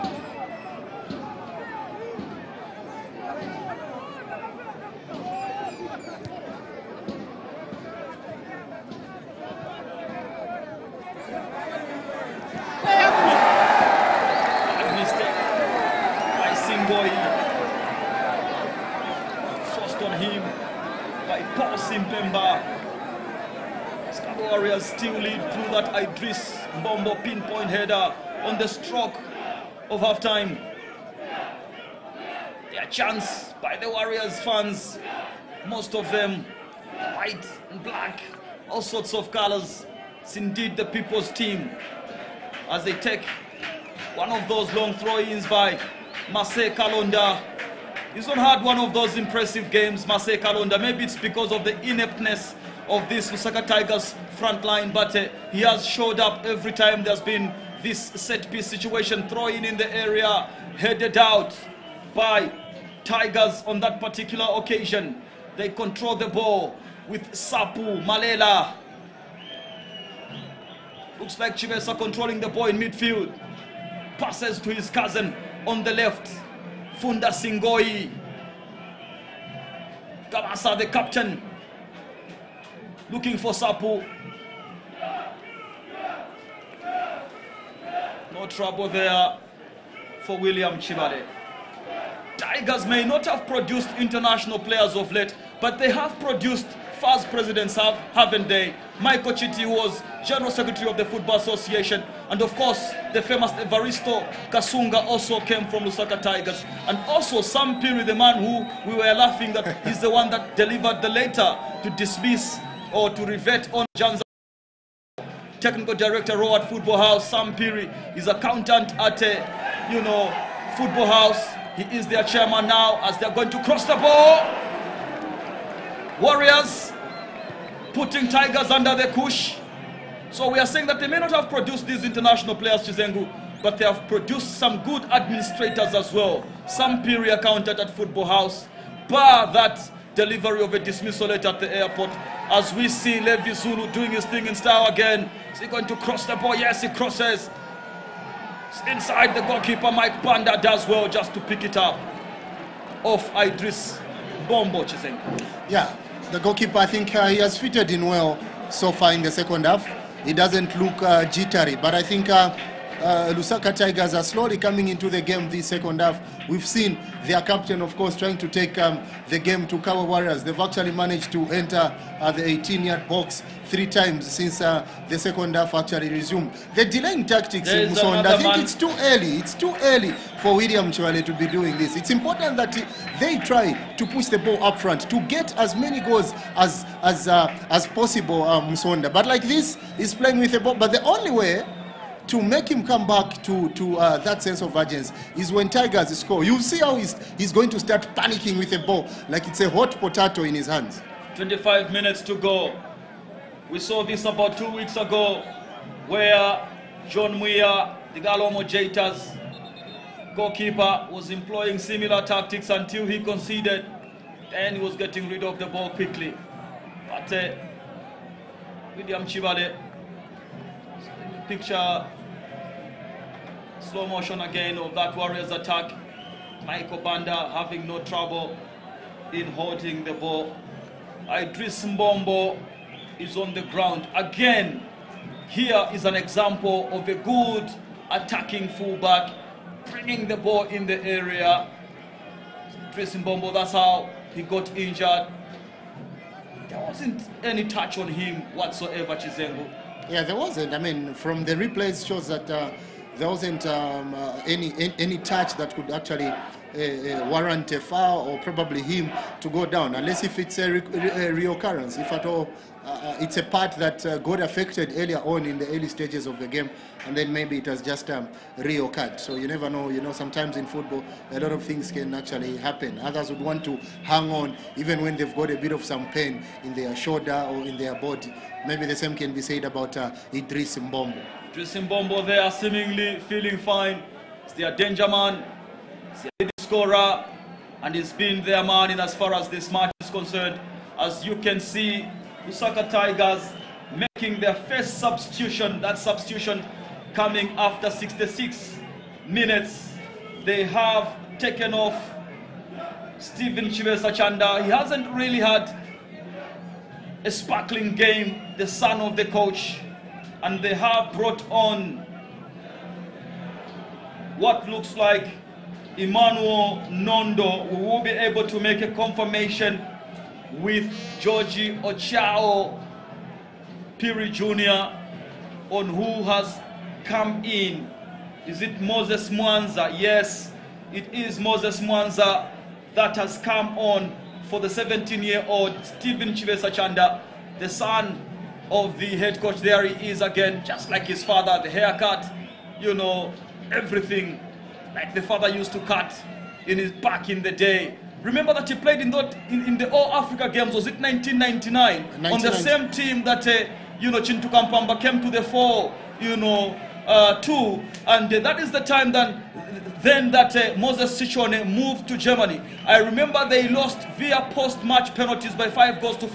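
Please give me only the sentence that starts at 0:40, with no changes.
It's indeed the people's team as they take one of those long throw-ins by Marcel Kalonda.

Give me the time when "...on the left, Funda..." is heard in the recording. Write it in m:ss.
1:15.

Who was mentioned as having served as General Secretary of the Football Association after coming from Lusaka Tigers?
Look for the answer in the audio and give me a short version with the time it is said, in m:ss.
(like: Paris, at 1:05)
Michael Chiti, at 1:38.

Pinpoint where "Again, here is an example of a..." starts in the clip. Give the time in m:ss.
3:54.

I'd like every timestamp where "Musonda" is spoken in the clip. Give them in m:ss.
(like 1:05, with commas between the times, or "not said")
2:57, 3:08.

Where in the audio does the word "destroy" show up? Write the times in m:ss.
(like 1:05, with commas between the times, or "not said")
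not said.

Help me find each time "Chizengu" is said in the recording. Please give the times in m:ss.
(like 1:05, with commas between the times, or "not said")
2:12, 4:09.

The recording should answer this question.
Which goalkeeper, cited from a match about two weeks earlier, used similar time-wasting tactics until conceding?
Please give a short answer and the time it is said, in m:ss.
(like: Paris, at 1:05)
John Muir, at 3:27.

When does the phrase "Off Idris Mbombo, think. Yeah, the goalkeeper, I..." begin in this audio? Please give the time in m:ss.
2:33.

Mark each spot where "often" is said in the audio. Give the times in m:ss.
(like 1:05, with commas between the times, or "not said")
not said.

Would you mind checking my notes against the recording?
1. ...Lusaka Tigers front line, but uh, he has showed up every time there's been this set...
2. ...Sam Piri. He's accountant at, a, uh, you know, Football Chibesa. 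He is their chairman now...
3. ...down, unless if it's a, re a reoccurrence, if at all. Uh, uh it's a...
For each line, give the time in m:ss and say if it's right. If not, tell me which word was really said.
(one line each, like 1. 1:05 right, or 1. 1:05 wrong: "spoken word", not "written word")
1. 0:53 right
2. 1:57 wrong: "House", not "Chibesa"
3. 4:19 right.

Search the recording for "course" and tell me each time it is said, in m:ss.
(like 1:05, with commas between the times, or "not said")
1:42, 2:47.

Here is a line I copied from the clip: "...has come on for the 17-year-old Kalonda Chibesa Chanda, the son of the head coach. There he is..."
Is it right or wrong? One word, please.
wrong.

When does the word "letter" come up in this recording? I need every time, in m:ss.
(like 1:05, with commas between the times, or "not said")
1:51.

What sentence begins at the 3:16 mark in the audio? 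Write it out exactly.
You see how he's, he's going to start panicking with a ball like it's a hot potato in his hands.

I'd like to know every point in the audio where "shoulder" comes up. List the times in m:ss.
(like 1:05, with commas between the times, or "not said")
4:36.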